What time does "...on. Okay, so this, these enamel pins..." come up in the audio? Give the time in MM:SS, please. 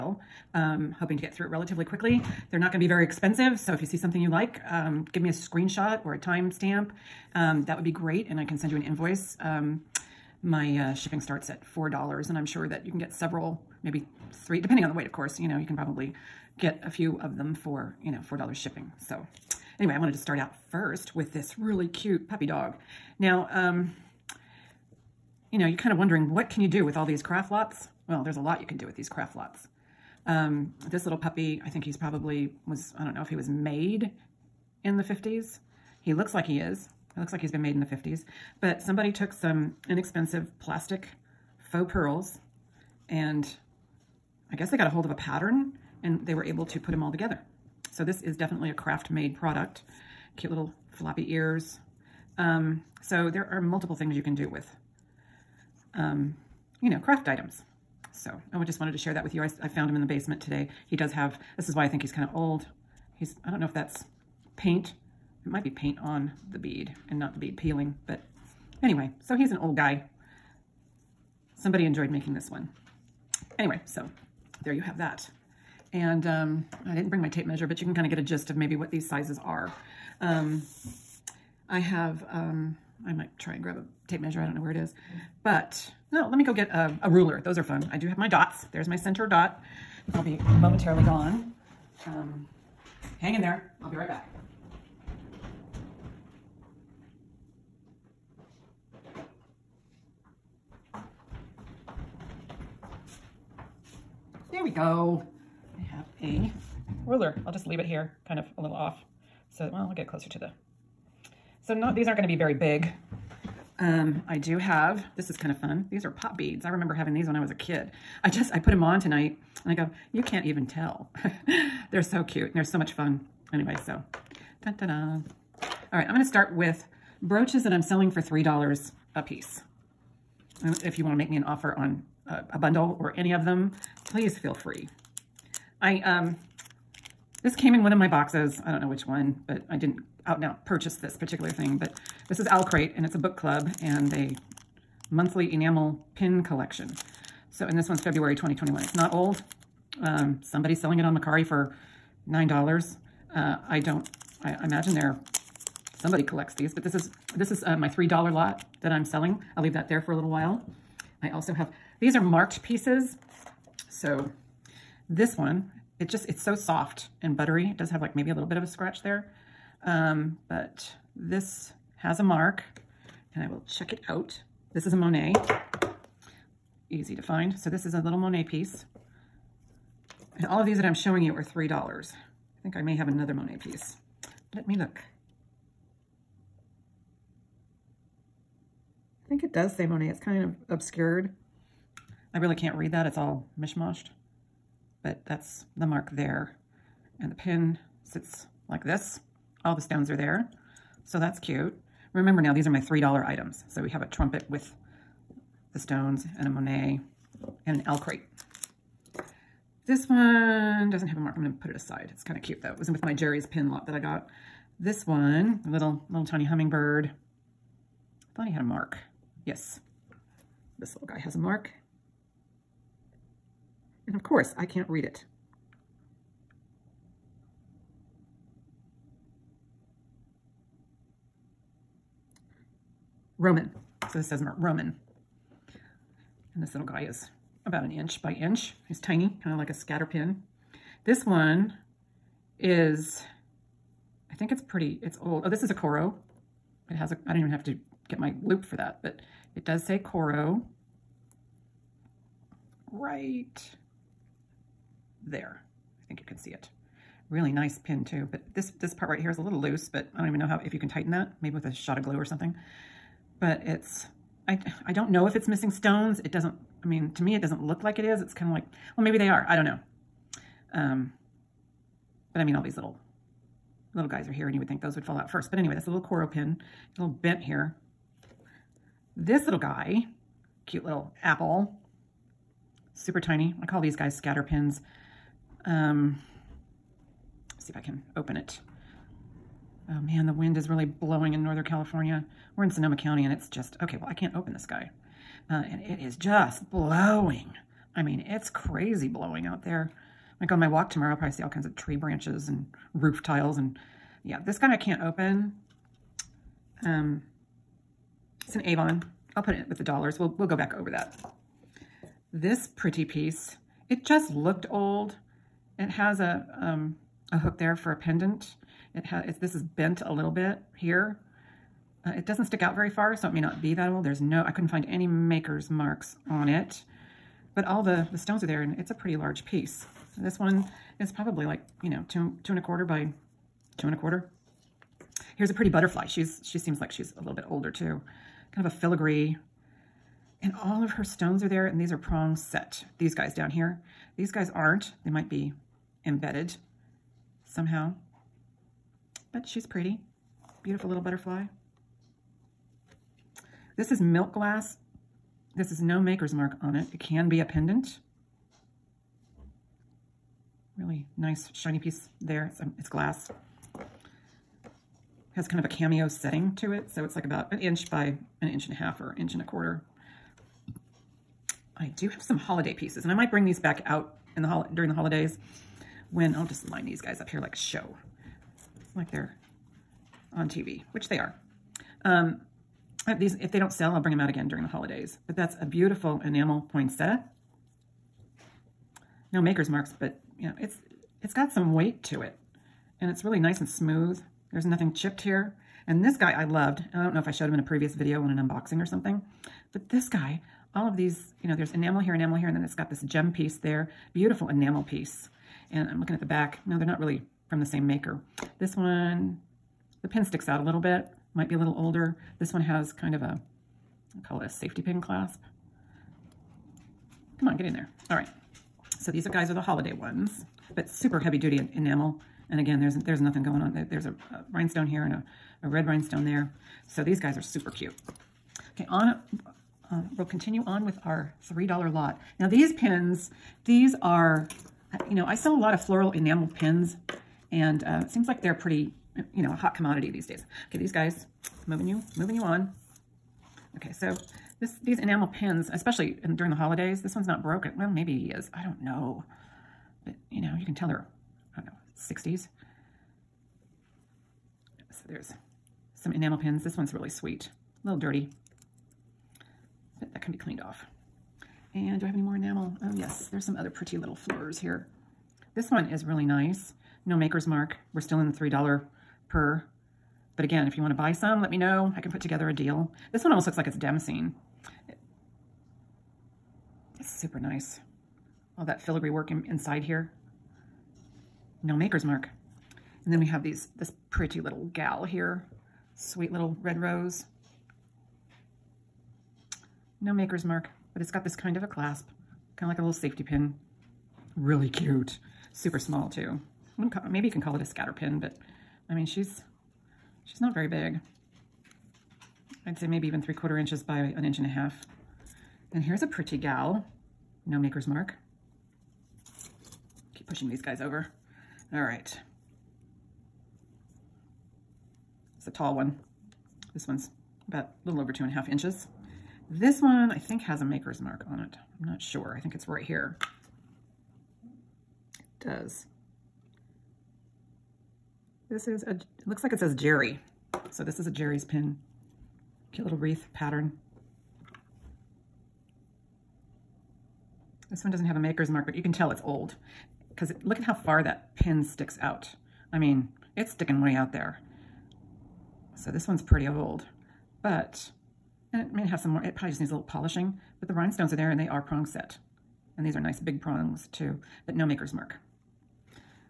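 07:22.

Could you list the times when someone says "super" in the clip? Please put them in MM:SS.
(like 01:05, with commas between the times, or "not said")
04:42, 07:00, 07:07, 07:57, 08:15.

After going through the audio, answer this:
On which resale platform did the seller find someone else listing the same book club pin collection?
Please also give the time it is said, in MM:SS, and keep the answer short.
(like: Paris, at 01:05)
Mercari, at 02:31.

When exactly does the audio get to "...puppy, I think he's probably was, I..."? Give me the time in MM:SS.
00:31.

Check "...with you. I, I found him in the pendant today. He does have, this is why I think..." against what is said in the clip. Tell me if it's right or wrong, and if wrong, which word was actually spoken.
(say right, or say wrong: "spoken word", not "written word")
wrong: "basement", not "pendant".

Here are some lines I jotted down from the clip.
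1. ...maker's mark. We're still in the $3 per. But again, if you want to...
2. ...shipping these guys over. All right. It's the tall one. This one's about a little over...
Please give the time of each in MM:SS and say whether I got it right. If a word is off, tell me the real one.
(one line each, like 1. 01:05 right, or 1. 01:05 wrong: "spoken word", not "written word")
1. 07:47 right
2. 08:30 wrong: "pushing", not "shipping".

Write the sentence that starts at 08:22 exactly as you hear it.
I'd say maybe even three quarter inches by an inch and a half.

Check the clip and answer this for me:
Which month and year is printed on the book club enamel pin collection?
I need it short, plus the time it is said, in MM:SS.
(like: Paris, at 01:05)
February 2021, at 02:27.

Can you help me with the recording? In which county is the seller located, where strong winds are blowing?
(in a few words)
Sonoma County.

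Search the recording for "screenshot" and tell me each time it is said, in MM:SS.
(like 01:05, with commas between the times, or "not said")
00:05.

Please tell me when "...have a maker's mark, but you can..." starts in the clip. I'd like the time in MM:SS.
08:58.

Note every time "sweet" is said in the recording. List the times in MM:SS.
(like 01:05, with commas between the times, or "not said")
07:37, 08:05.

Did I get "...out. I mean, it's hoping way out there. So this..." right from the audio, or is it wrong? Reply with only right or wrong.
wrong.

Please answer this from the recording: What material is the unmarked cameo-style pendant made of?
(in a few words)
milk glass.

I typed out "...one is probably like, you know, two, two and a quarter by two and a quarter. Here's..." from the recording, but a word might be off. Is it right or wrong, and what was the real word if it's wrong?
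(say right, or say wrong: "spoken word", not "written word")
right.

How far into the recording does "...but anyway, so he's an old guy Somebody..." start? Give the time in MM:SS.
01:08.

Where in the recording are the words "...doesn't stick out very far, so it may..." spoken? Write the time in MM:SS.
05:22.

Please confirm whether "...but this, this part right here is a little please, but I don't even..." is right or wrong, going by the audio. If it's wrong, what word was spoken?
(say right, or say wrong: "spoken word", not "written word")
wrong: "loose", not "please".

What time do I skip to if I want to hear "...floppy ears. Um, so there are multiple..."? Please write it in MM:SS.
00:50.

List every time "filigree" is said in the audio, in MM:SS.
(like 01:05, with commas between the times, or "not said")
05:38, 07:58.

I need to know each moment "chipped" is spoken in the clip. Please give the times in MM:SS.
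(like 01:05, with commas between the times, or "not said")
06:34.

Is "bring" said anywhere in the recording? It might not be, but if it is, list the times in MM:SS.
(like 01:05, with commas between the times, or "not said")
01:17, 06:13, 06:23.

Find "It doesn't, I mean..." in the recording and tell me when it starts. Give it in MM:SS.
04:26.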